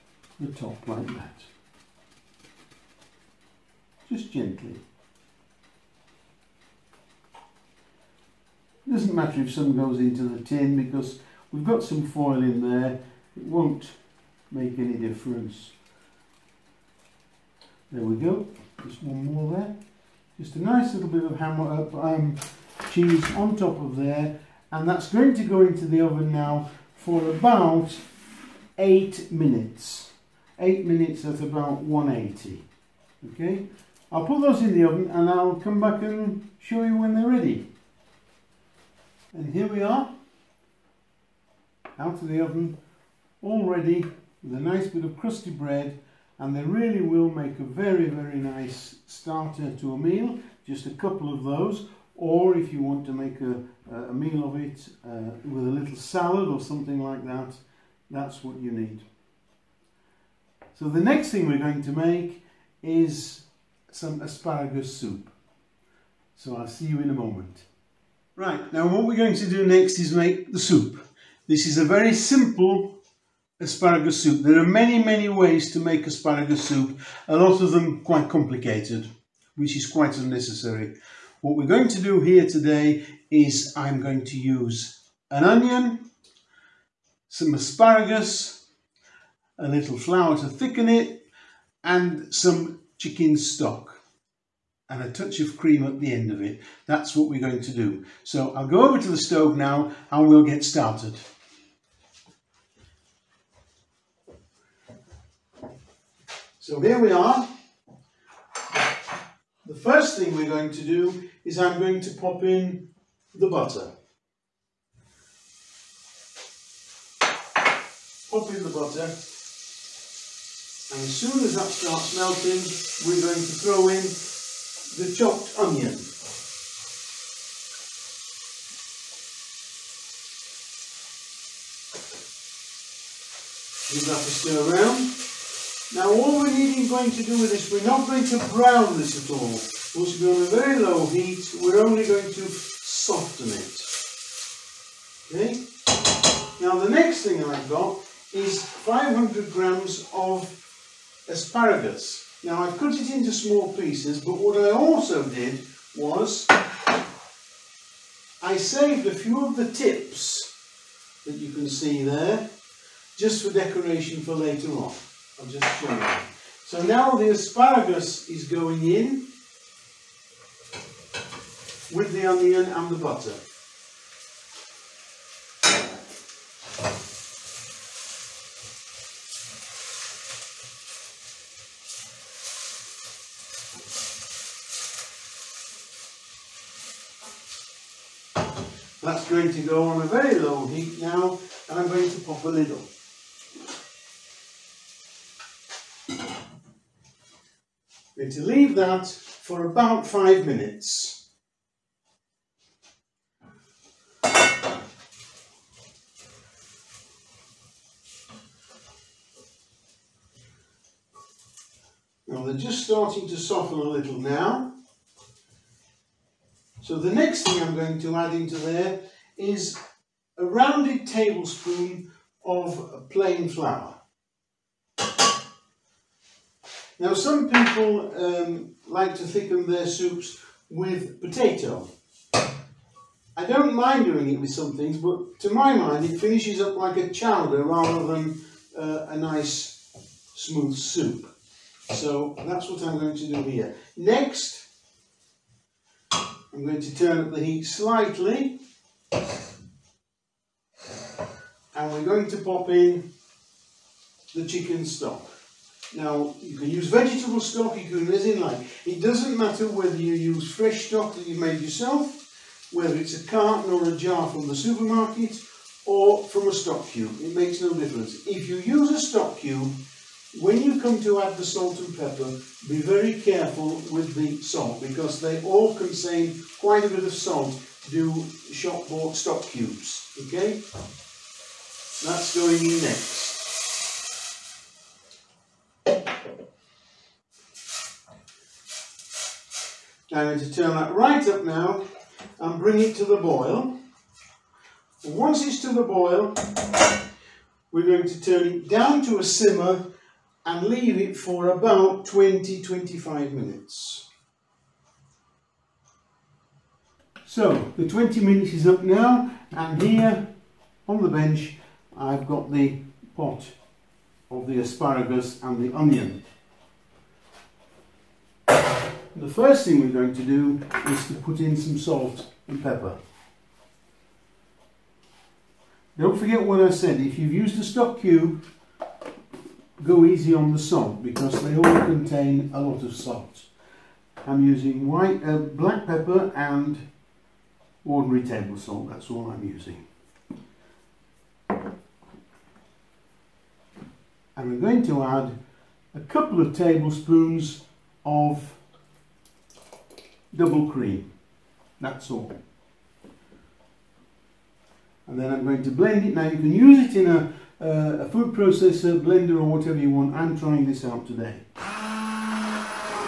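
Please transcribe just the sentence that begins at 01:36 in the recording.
That's what we're going to do.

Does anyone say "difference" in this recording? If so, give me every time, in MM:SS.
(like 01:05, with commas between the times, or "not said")
00:14, 04:27.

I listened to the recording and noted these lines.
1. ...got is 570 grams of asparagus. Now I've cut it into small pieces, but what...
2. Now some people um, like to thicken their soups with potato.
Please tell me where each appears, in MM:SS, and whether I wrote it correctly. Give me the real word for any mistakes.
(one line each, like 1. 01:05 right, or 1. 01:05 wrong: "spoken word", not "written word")
1. 02:27 wrong: "500", not "570"
2. 03:46 right.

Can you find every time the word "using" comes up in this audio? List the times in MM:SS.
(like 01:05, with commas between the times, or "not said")
05:34, 05:39.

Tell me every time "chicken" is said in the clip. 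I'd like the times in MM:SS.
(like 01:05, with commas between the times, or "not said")
01:32, 04:14.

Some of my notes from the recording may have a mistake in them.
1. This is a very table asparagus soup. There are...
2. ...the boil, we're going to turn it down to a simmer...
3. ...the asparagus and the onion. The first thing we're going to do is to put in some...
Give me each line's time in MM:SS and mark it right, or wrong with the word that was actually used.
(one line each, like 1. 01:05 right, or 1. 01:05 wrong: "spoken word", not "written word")
1. 01:11 wrong: "simple", not "table"
2. 04:55 right
3. 05:14 right.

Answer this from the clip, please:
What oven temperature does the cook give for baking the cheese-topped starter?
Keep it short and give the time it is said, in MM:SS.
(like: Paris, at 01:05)
180, at 00:31.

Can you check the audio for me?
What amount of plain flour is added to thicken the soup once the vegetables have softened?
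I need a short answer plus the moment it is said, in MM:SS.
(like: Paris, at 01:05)
a rounded tablespoon, at 03:40.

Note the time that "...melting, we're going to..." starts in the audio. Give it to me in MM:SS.
02:02.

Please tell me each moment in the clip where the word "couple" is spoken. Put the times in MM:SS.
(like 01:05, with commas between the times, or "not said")
00:50, 05:46.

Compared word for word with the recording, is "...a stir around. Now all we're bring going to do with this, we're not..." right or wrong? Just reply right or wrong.
wrong.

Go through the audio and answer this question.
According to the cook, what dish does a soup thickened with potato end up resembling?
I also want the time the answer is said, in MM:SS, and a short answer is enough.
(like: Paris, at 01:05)
chowder, at 03:56.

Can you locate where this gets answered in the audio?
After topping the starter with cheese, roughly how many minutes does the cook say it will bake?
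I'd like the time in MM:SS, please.
00:27.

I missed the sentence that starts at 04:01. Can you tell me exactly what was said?
So that's what I'm going to do here.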